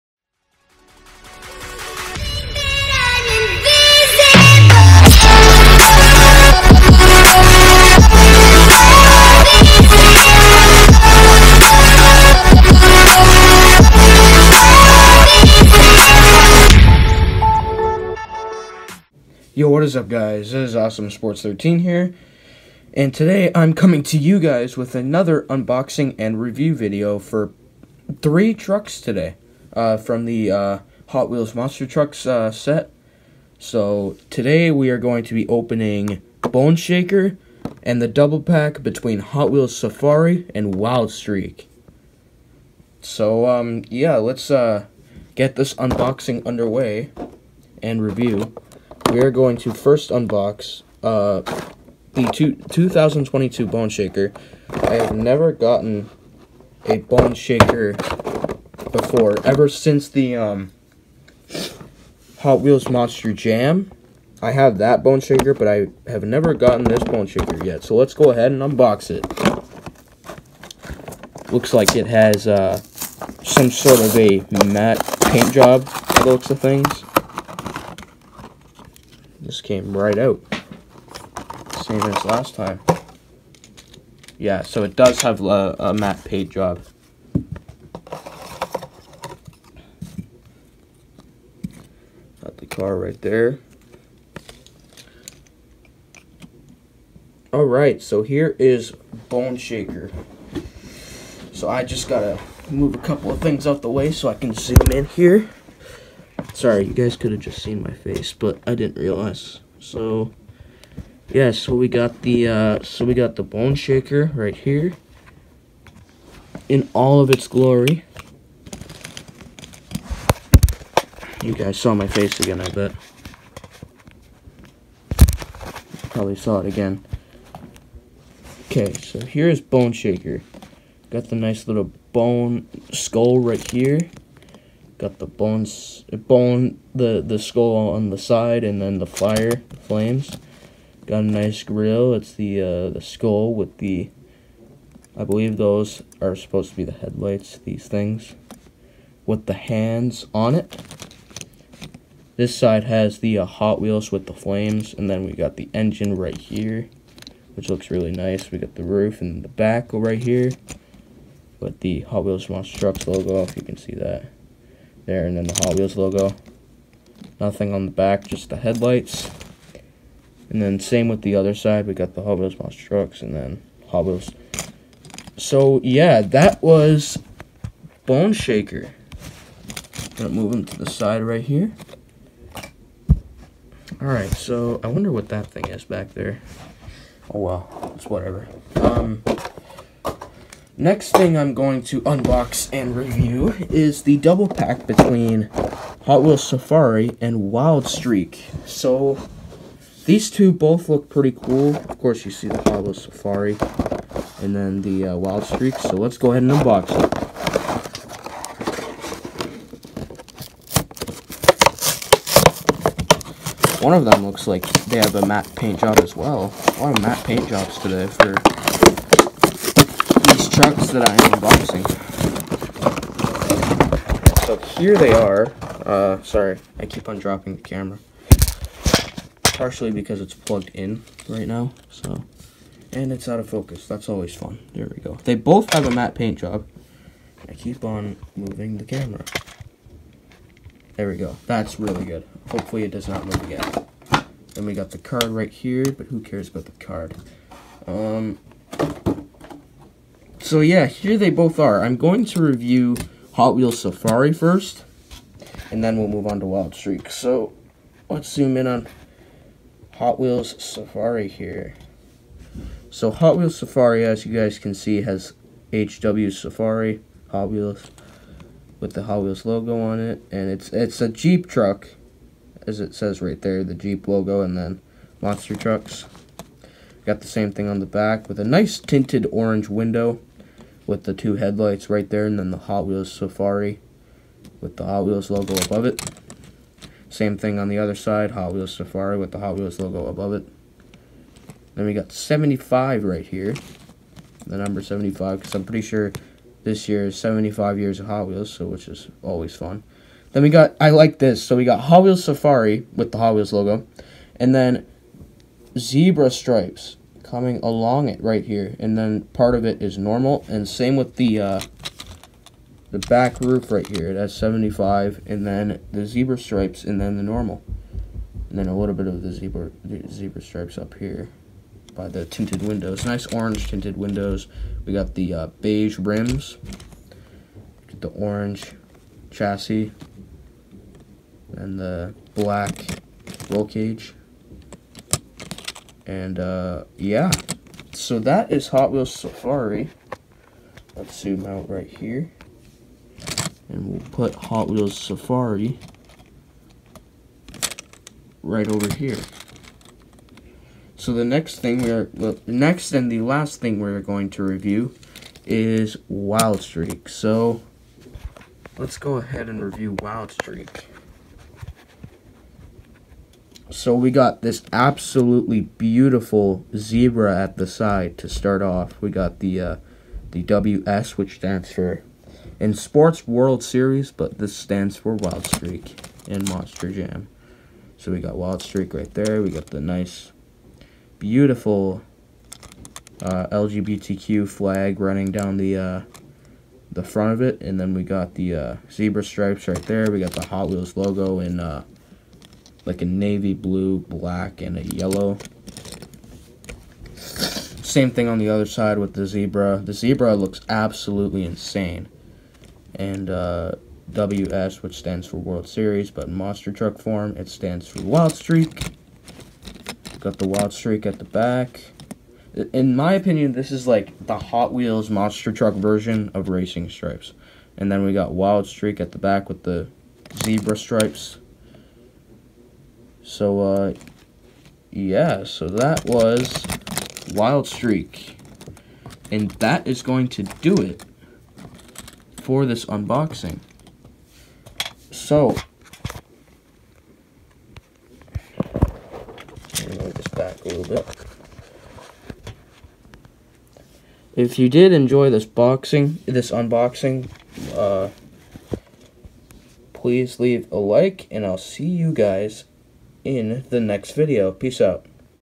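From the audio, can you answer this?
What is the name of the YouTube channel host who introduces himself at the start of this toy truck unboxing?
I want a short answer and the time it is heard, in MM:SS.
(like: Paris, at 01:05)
Awesome Sports 13, at 00:20.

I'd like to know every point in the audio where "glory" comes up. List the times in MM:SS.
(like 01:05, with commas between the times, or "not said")
01:57.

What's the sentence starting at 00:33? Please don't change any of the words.
So, today we are going to be opening Bone Shaker and the double pack between Hot Wheels Safari and Wild Streak.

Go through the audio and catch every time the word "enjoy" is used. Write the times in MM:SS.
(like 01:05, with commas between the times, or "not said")
07:24.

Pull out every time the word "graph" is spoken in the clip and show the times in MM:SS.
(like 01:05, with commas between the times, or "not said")
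not said.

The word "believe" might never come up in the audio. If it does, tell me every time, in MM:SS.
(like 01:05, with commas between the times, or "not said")
02:25.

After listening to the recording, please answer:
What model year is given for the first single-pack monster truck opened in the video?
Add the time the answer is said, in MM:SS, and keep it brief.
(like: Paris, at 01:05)
2022, at 00:52.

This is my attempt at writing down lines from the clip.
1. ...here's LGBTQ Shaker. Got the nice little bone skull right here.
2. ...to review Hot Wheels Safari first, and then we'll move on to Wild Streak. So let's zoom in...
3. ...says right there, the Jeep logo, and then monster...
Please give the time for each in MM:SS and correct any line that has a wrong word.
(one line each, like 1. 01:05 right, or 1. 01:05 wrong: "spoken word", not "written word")
1. 02:09 wrong: "Bone", not "LGBTQ"
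2. 04:12 right
3. 04:32 right.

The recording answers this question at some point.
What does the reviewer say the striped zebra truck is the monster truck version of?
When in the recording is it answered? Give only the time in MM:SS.
06:56.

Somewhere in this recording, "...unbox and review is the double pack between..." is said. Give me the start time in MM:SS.
03:12.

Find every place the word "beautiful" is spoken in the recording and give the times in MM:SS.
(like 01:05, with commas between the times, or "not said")
06:05, 06:21.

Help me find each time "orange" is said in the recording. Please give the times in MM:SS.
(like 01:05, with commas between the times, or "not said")
04:39, 05:23, 05:28.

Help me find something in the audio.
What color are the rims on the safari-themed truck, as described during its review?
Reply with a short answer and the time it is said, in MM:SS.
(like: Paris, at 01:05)
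Beige, at 05:25.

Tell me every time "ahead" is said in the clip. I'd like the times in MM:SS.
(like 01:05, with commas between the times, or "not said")
01:08, 03:26, 05:59.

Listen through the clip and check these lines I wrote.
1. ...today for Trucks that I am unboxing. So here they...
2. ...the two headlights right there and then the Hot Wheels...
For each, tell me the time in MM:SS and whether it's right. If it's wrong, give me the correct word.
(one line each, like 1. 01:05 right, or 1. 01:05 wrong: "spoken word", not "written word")
1. 03:37 right
2. 04:41 right.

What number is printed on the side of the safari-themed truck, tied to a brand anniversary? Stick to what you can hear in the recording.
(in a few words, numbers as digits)
75.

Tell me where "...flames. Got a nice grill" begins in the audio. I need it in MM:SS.
02:19.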